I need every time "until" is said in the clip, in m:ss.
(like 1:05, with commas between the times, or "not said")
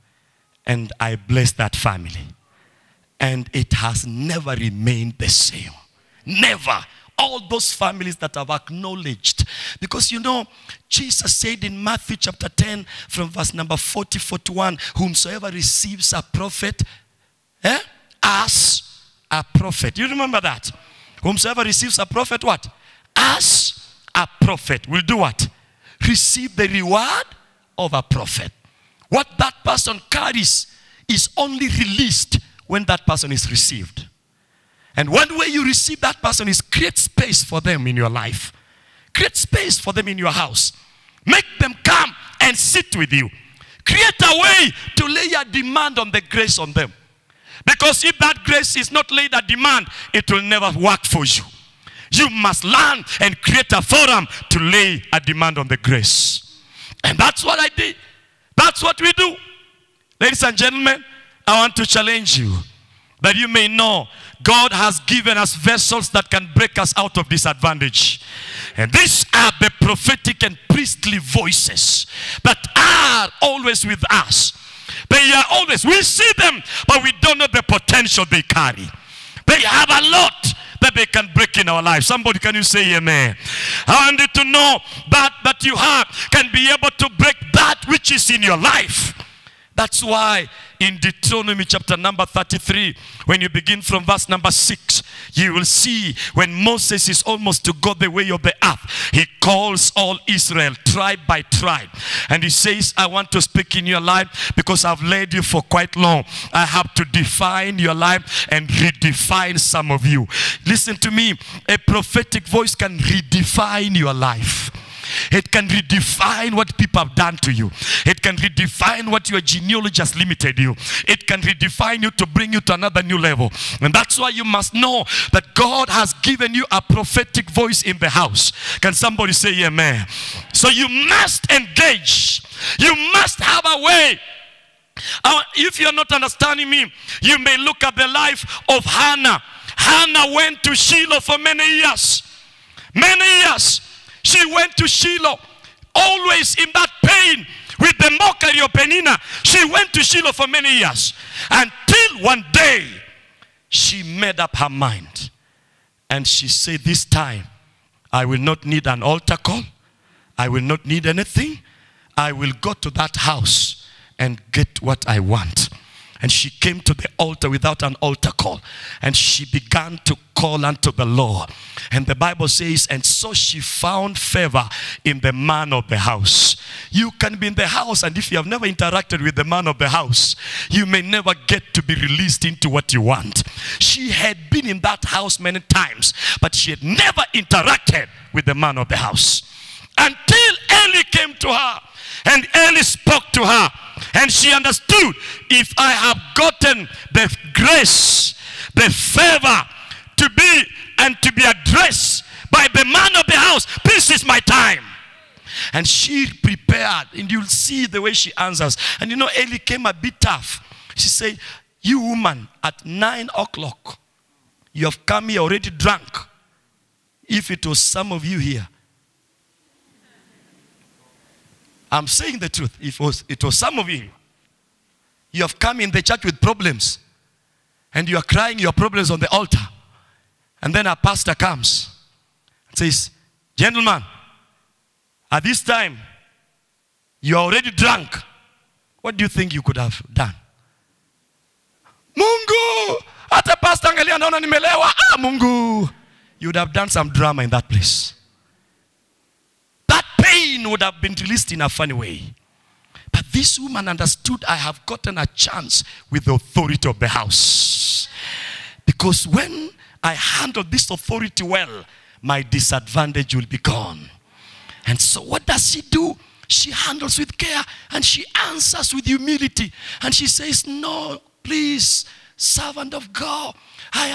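2:31, 3:09.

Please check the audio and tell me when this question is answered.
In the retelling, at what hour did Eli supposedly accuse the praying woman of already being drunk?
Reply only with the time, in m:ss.
3:32.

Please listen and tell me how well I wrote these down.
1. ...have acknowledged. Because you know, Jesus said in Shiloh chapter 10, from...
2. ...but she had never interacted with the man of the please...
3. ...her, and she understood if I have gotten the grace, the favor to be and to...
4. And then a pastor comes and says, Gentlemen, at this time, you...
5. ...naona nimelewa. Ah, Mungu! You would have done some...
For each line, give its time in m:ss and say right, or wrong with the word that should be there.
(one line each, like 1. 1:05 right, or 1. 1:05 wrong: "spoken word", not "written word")
1. 0:08 wrong: "Matthew", not "Shiloh"
2. 3:06 wrong: "house", not "please"
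3. 3:13 right
4. 3:50 right
5. 4:04 right.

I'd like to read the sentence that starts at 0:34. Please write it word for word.
And one way you receive that person is create space for them in your life.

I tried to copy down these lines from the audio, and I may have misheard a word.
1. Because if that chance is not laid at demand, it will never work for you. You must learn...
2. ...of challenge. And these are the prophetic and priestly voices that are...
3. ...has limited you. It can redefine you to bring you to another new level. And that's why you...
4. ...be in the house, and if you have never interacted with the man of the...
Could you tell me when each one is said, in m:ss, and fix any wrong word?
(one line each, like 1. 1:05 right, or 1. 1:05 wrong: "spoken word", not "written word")
1. 0:47 wrong: "grace", not "chance"
2. 1:07 wrong: "disadvantage", not "challenge"
3. 2:00 right
4. 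2:57 right.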